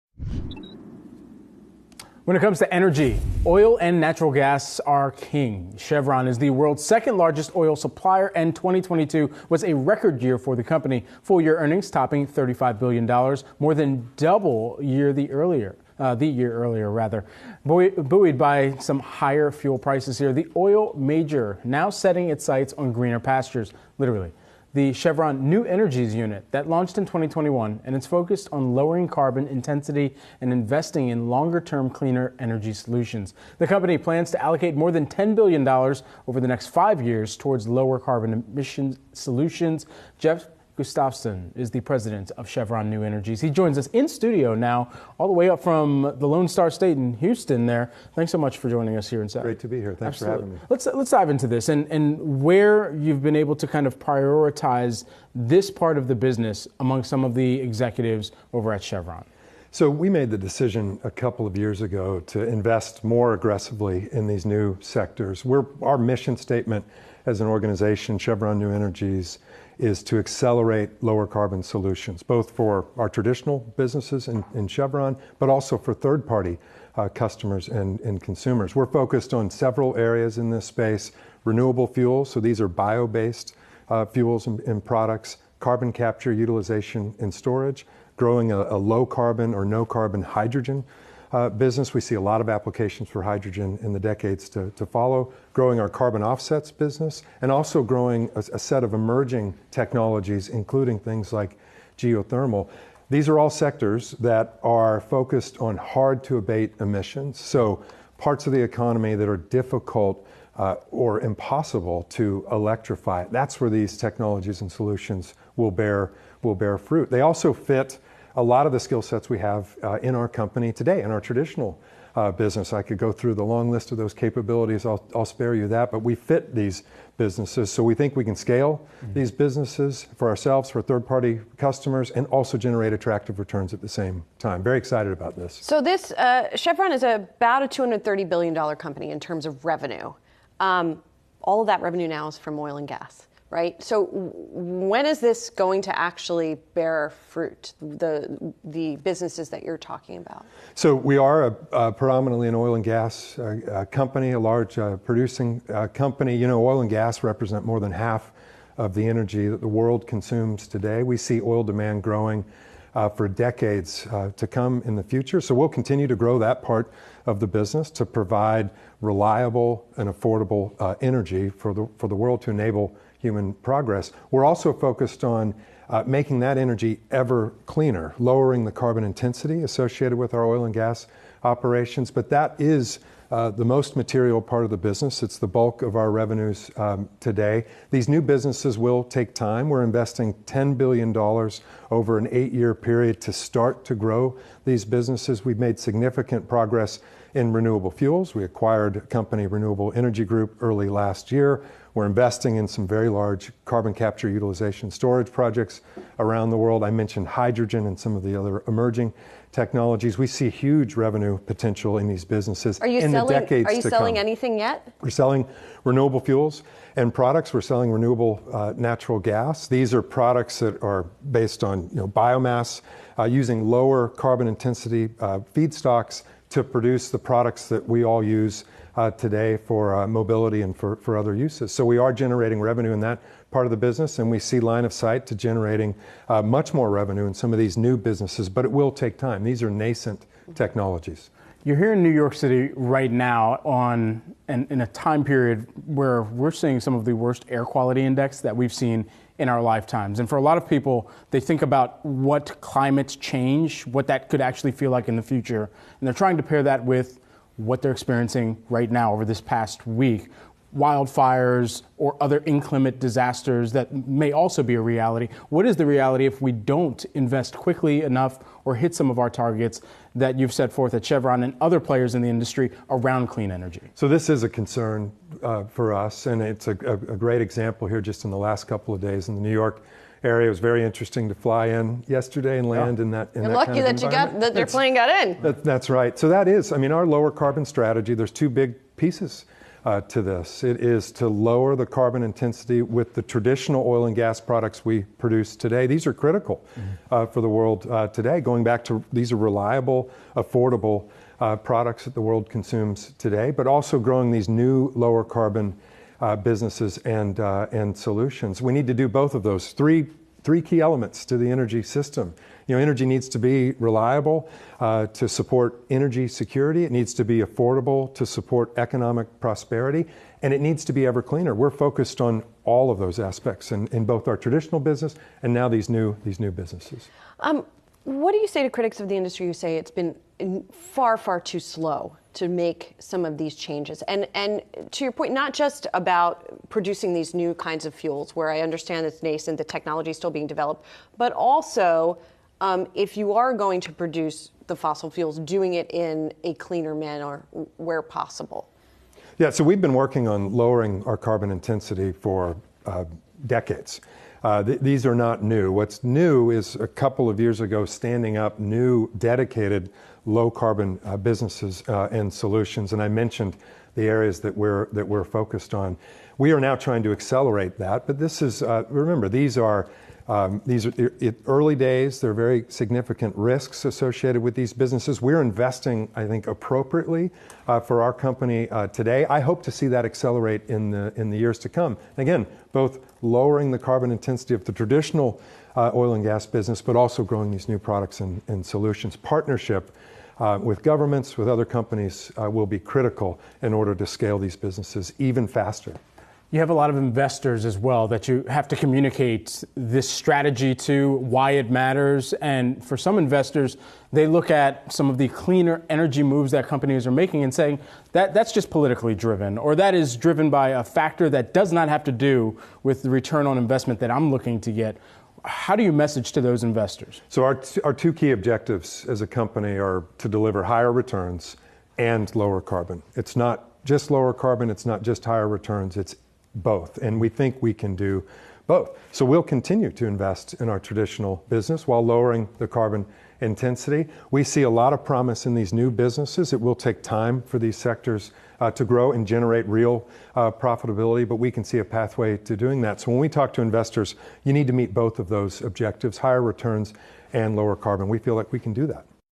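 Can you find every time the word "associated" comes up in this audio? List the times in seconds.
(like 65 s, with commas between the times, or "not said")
179 s, 373 s.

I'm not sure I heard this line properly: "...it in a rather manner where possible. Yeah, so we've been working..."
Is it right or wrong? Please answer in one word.
wrong.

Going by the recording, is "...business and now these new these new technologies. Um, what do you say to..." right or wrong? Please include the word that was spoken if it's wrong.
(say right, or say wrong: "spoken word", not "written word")
wrong: "businesses", not "technologies".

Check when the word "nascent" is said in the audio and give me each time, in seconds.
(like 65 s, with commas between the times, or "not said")
239 s, 339 s.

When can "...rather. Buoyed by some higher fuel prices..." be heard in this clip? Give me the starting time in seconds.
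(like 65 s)
16 s.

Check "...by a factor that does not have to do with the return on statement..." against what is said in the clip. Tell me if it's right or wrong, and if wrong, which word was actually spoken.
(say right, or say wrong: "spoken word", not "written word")
wrong: "investment", not "statement".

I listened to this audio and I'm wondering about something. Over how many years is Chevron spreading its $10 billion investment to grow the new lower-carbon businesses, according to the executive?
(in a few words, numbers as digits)
8 years.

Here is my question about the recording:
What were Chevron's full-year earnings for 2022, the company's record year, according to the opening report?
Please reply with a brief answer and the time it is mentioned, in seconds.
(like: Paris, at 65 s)
$35 billion, at 12 s.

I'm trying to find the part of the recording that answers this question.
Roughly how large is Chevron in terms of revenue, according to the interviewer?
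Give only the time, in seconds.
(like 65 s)
137 s.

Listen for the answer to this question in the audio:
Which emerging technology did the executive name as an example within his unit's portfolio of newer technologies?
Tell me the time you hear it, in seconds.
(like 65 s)
101 s.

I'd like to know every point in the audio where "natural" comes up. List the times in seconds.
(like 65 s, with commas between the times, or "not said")
3 s, 218 s.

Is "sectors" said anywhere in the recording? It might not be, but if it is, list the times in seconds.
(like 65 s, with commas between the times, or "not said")
64 s, 103 s, 437 s.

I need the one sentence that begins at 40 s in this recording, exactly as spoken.
Jeff Gustavson is the president of Chevron New Energies.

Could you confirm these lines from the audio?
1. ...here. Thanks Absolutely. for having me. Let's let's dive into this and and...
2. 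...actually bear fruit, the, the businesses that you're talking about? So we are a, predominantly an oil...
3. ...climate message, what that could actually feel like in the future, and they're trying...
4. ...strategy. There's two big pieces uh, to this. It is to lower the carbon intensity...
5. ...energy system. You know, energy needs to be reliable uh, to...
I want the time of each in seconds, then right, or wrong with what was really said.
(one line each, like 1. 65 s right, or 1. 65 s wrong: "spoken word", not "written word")
1. 49 s right
2. 145 s right
3. 252 s wrong: "change", not "message"
4. 287 s right
5. 311 s right.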